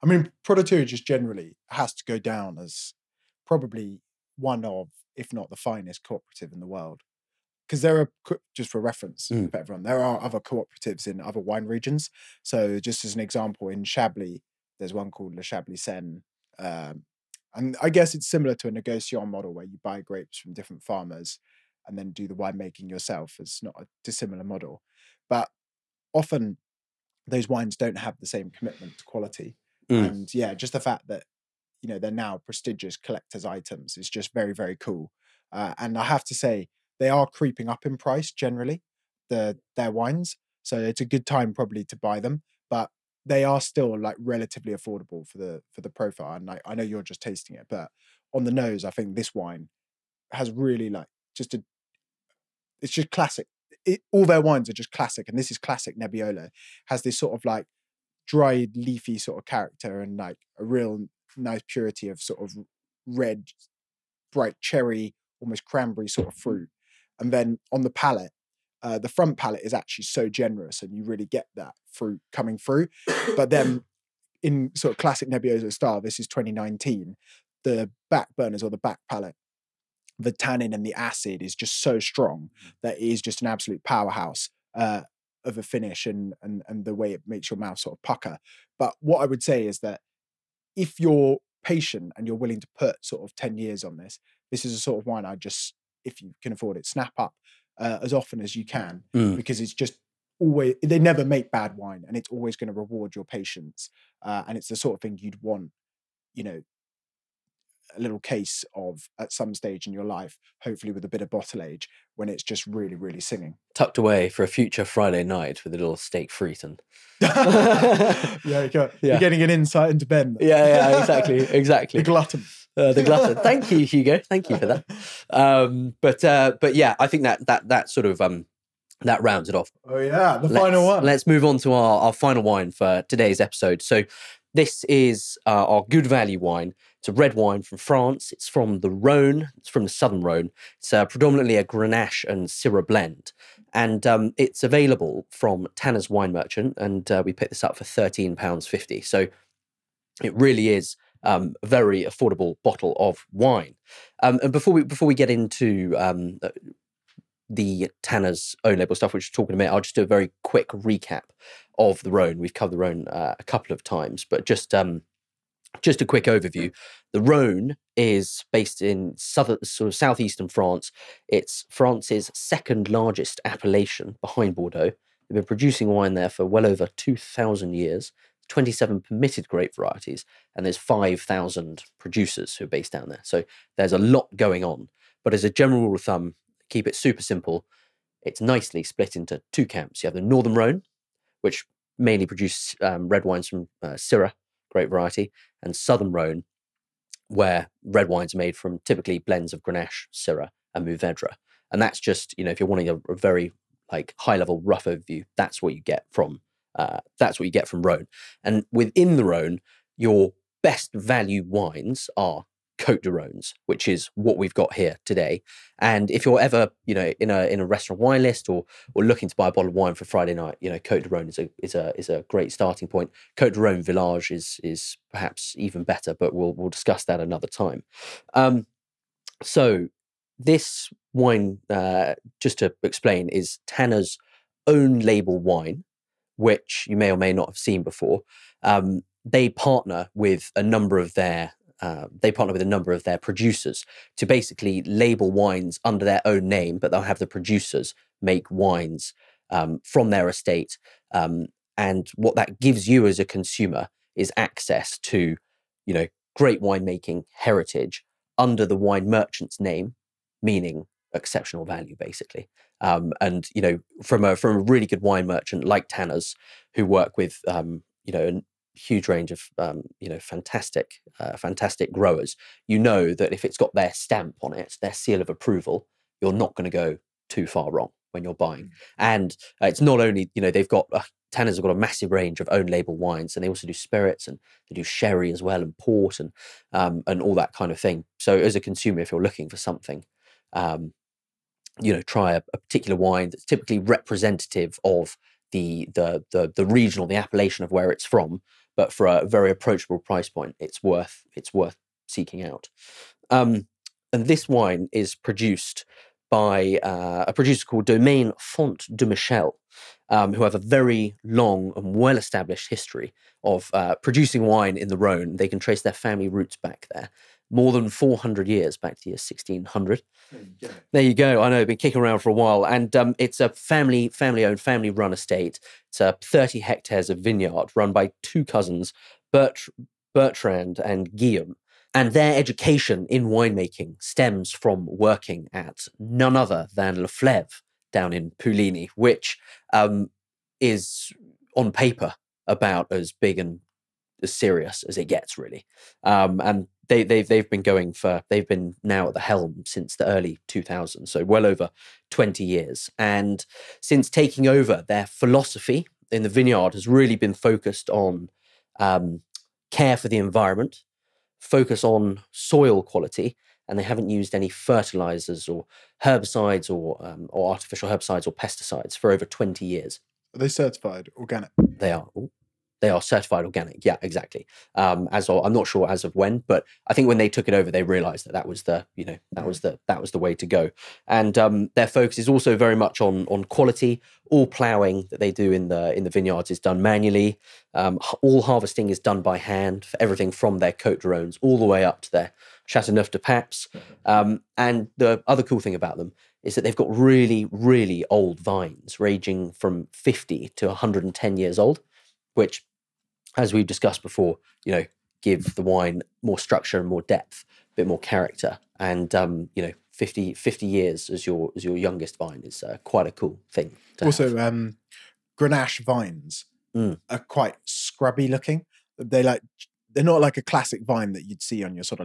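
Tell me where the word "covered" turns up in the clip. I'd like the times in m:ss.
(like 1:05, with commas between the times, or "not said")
2:42.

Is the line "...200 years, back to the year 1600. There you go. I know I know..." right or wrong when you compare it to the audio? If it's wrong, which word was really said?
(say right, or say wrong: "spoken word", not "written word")
wrong: "400", not "200".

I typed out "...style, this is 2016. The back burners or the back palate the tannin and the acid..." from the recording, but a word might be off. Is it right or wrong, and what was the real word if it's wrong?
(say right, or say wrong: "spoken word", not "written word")
wrong: "2019", not "2016".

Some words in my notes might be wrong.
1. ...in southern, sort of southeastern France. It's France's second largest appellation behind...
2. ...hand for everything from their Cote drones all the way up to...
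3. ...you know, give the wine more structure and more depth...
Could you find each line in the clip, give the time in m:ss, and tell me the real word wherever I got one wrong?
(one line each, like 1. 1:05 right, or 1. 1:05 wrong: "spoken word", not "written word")
1. 2:48 right
2. 6:29 right
3. 6:44 right.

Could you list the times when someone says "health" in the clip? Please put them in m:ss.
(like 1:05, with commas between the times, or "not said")
not said.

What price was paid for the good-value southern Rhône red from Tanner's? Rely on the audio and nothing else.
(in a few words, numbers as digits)
£13.50.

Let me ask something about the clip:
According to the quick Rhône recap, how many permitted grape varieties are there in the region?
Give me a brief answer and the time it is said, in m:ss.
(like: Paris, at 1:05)
27, at 2:58.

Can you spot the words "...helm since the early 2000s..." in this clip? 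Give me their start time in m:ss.
5:49.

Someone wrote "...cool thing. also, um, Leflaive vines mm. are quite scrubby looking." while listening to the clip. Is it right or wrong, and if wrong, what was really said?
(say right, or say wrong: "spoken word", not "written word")
wrong: "Grenache", not "Leflaive".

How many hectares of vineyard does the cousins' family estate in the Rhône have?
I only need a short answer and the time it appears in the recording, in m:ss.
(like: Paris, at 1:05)
30, at 5:26.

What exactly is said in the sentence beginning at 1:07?
And then on the palate, uh, the front palate is actually so generous, and you really get that fruit coming through.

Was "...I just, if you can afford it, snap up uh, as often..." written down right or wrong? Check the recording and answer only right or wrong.
right.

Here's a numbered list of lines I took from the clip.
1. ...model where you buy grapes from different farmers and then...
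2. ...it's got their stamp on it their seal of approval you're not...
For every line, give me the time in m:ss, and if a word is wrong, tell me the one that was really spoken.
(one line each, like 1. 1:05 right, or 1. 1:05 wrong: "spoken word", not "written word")
1. 0:19 right
2. 4:33 right.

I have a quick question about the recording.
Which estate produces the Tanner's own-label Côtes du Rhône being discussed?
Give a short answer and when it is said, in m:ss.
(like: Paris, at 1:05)
Domaine Font de Michel, at 5:07.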